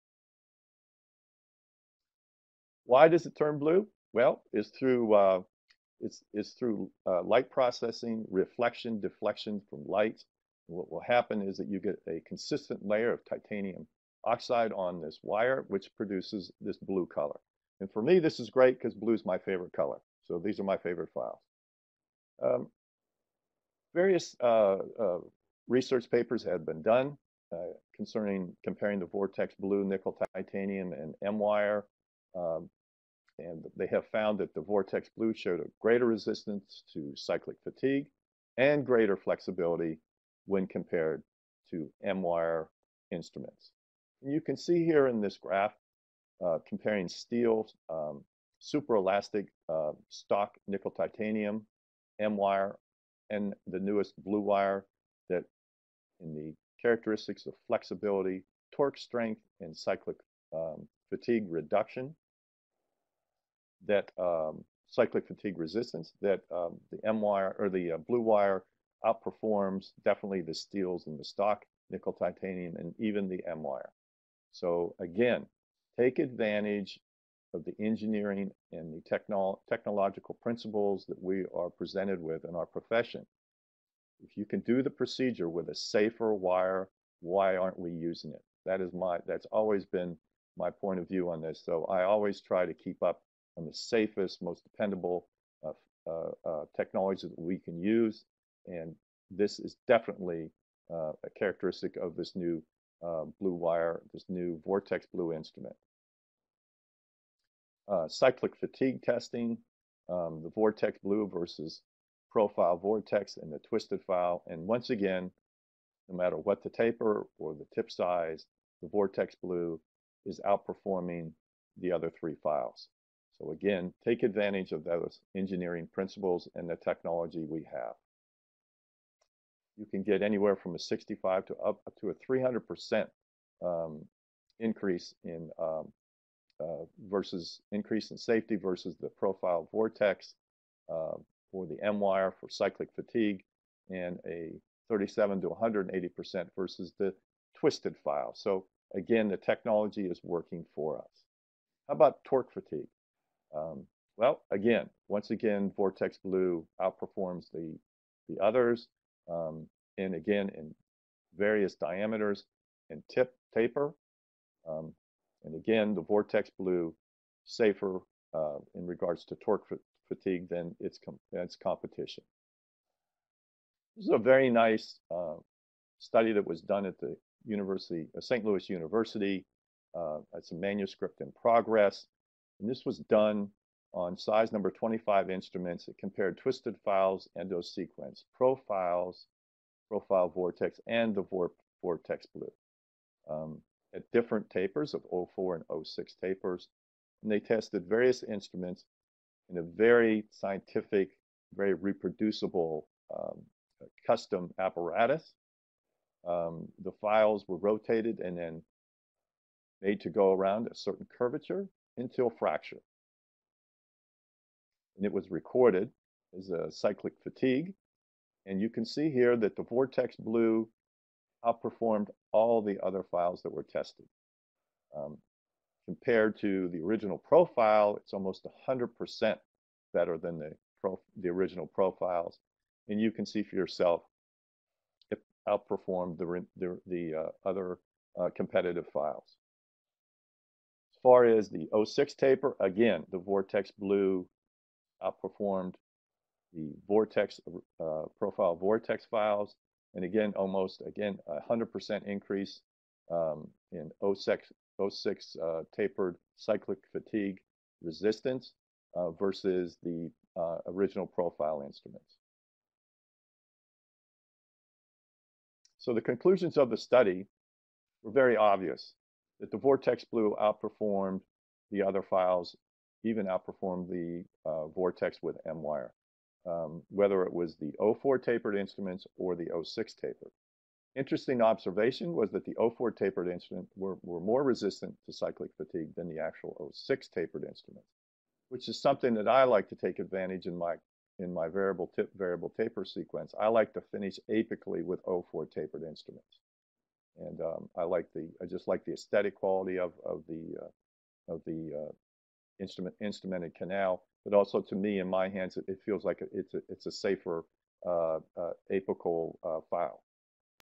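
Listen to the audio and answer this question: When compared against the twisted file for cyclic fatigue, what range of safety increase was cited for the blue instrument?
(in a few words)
37 to 180%.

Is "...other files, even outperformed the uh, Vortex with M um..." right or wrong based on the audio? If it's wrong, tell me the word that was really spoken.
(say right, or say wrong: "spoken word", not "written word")
right.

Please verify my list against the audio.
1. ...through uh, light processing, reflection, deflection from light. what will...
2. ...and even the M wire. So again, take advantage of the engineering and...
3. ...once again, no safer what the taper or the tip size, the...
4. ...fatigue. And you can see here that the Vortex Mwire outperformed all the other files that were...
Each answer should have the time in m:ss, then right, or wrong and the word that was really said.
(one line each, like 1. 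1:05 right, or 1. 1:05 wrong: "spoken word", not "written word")
1. 0:06 right
2. 1:12 right
3. 1:54 wrong: "matter", not "safer"
4. 3:37 wrong: "Blue", not "Mwire".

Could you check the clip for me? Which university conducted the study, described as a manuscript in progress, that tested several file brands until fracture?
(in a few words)
St. Louis University.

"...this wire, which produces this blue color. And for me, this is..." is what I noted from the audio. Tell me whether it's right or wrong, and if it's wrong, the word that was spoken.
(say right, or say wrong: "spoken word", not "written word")
right.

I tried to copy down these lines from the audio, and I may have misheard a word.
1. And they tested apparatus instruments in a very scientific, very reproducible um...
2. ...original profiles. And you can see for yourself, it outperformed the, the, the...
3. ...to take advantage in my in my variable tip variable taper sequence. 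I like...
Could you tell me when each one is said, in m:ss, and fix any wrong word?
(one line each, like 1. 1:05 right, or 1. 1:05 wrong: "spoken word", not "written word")
1. 3:17 wrong: "various", not "apparatus"
2. 3:51 right
3. 4:49 right.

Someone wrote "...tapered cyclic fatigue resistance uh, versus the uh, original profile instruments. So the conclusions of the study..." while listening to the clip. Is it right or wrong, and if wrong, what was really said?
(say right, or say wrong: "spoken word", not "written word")
right.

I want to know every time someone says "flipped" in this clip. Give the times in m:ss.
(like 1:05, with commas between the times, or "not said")
not said.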